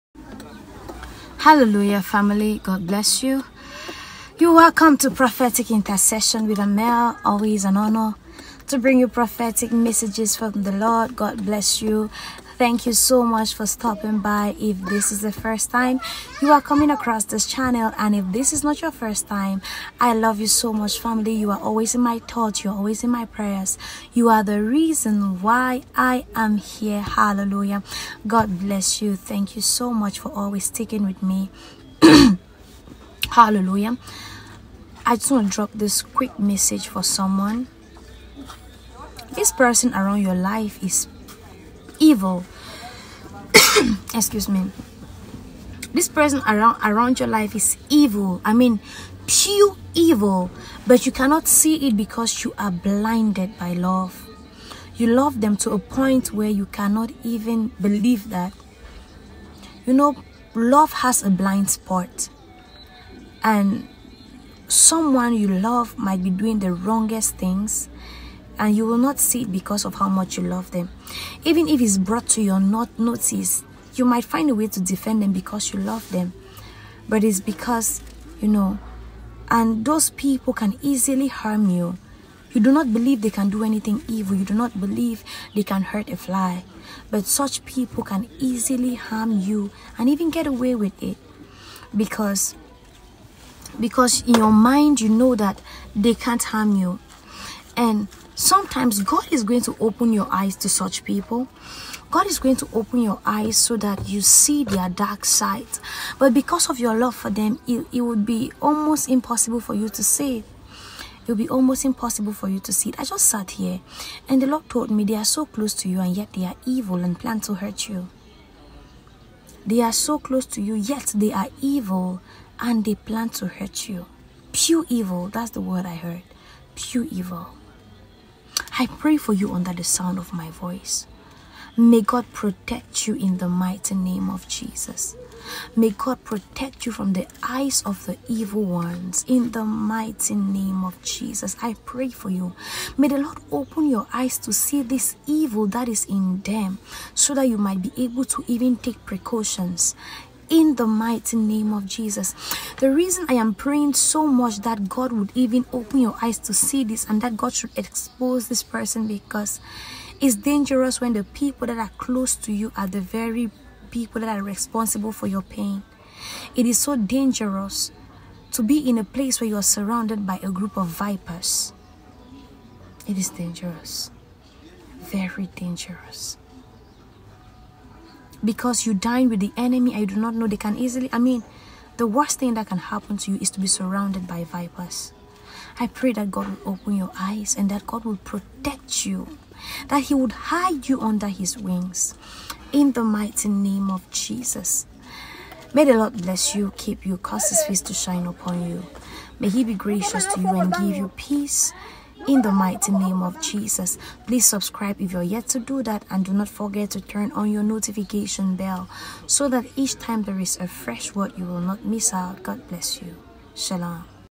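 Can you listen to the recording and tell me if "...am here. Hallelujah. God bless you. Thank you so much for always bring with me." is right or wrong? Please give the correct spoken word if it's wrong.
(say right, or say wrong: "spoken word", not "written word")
wrong: "sticking", not "bring".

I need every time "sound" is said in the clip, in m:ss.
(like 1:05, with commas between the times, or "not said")
2:09.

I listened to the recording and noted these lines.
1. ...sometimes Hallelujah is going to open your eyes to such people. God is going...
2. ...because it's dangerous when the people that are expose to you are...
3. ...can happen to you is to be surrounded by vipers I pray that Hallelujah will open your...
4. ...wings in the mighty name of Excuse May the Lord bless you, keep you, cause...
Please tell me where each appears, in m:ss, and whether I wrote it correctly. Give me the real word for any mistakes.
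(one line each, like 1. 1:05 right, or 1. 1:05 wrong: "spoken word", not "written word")
1. 1:38 wrong: "God", not "Hallelujah"
2. 2:39 wrong: "close", not "expose"
3. 3:02 wrong: "God", not "Hallelujah"
4. 3:11 wrong: "Jesus", not "Excuse".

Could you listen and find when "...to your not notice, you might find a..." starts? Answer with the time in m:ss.
1:12.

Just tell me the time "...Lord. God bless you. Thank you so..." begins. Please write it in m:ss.
0:10.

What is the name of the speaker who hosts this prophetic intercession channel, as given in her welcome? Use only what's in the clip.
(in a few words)
Armelle.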